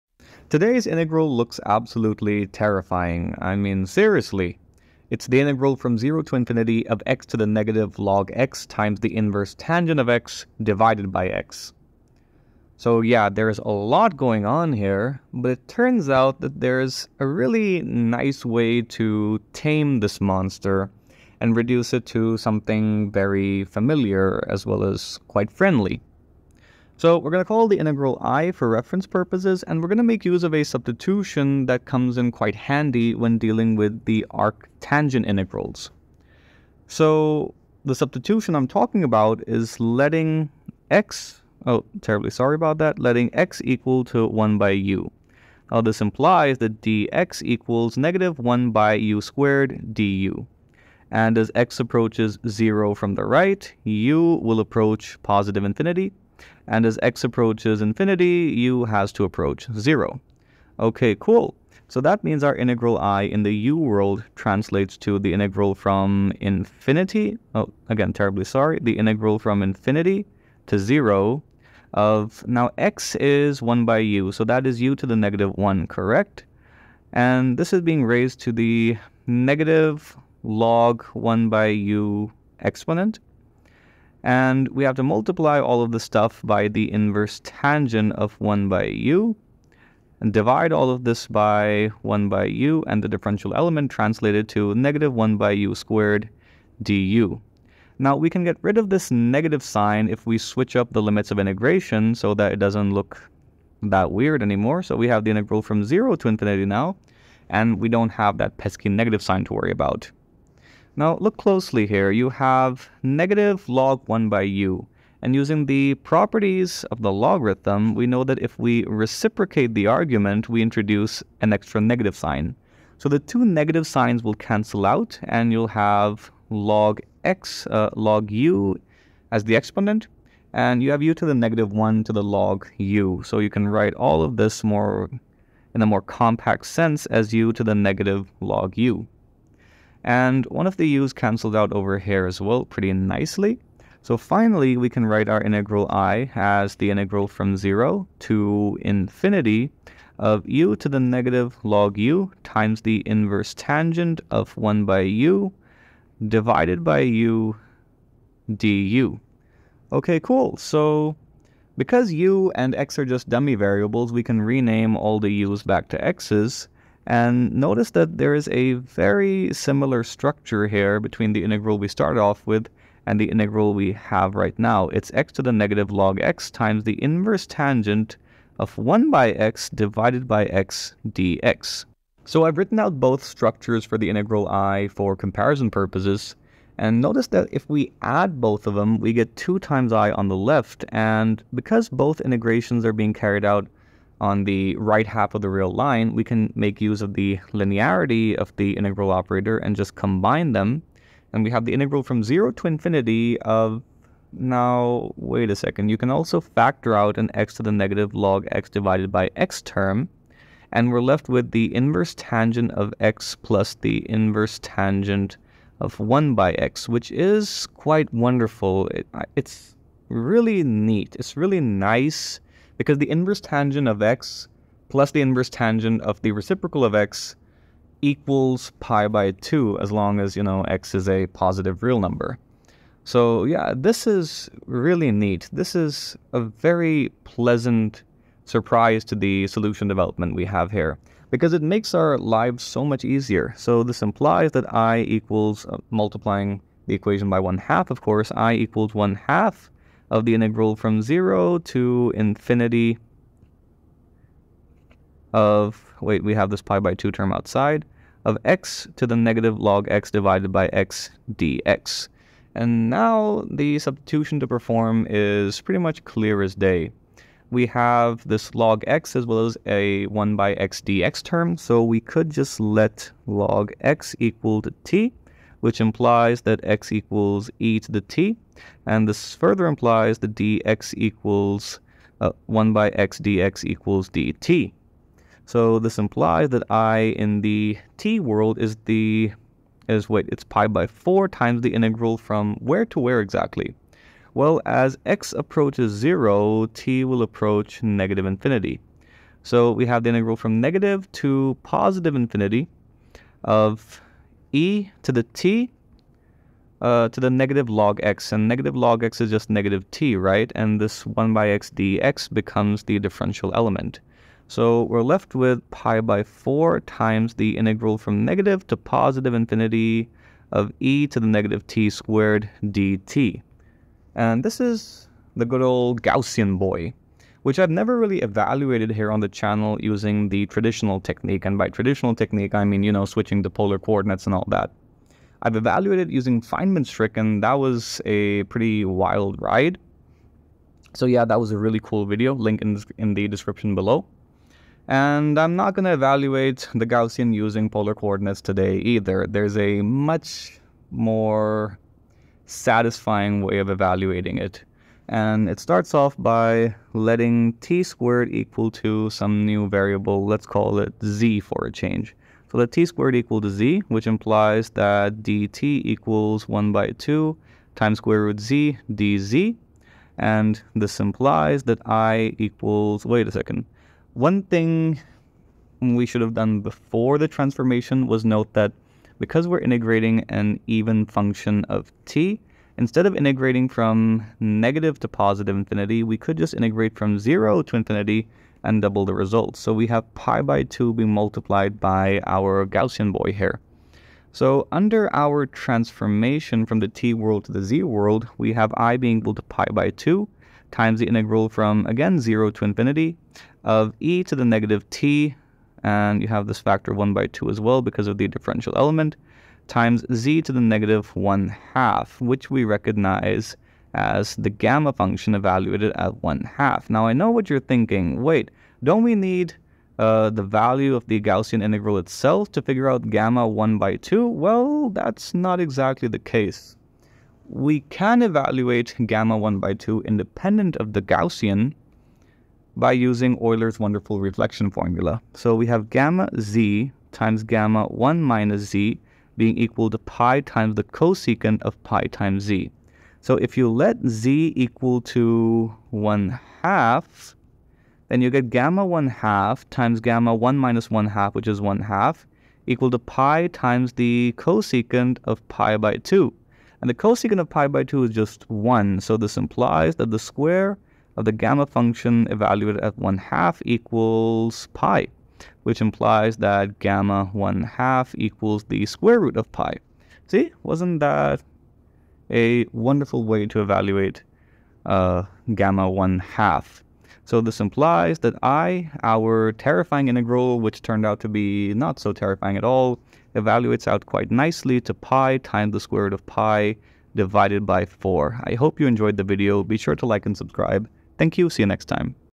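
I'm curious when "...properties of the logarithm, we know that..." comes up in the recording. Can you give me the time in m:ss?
1:55.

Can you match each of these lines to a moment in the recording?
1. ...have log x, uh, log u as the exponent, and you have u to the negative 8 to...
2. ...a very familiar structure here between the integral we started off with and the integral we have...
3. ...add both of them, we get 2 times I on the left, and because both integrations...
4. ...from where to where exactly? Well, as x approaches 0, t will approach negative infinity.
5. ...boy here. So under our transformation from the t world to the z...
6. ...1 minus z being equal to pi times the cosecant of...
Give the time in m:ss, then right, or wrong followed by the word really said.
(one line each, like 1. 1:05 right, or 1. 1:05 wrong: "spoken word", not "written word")
1. 2:05 wrong: "1", not "8"
2. 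2:48 wrong: "similar", not "familiar"
3. 3:08 right
4. 4:52 right
5. 6:33 right
6. 7:17 right.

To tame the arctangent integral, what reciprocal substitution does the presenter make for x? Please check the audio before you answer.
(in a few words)
x = 1/u.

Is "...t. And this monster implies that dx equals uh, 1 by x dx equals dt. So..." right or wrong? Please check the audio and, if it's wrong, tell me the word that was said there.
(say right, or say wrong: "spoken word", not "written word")
wrong: "further", not "monster".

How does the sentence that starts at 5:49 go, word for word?
There's a much more satisfying way of evaluating it.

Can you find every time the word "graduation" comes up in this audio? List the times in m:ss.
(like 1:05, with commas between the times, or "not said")
not said.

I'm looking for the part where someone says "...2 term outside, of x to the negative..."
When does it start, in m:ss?
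4:16.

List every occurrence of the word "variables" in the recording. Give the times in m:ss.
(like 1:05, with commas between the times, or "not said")
2:43, 5:59.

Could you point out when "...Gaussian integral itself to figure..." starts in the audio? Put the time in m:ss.
7:01.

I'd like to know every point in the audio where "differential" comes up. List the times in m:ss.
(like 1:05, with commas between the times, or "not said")
1:33, 5:12, 6:48.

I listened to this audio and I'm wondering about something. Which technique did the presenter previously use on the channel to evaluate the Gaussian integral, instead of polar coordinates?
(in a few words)
Feynman's trick.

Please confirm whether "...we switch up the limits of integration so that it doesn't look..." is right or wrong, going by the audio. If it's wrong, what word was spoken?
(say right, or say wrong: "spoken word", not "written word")
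right.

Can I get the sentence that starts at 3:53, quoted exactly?
So yeah, this is really neat.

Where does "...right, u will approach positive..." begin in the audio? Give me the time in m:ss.
0:53.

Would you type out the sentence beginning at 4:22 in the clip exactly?
And now the substitution to perform is pretty much clear as day.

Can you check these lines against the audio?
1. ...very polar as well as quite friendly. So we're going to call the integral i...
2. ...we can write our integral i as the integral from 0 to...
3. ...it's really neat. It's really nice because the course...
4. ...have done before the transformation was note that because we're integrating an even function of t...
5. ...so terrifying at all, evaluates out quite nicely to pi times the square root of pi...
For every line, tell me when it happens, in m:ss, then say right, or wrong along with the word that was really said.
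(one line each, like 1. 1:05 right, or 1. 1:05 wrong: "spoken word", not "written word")
1. 0:23 wrong: "familiar", not "polar"
2. 2:24 right
3. 3:39 wrong: "inverse", not "course"
4. 6:16 right
5. 8:01 right.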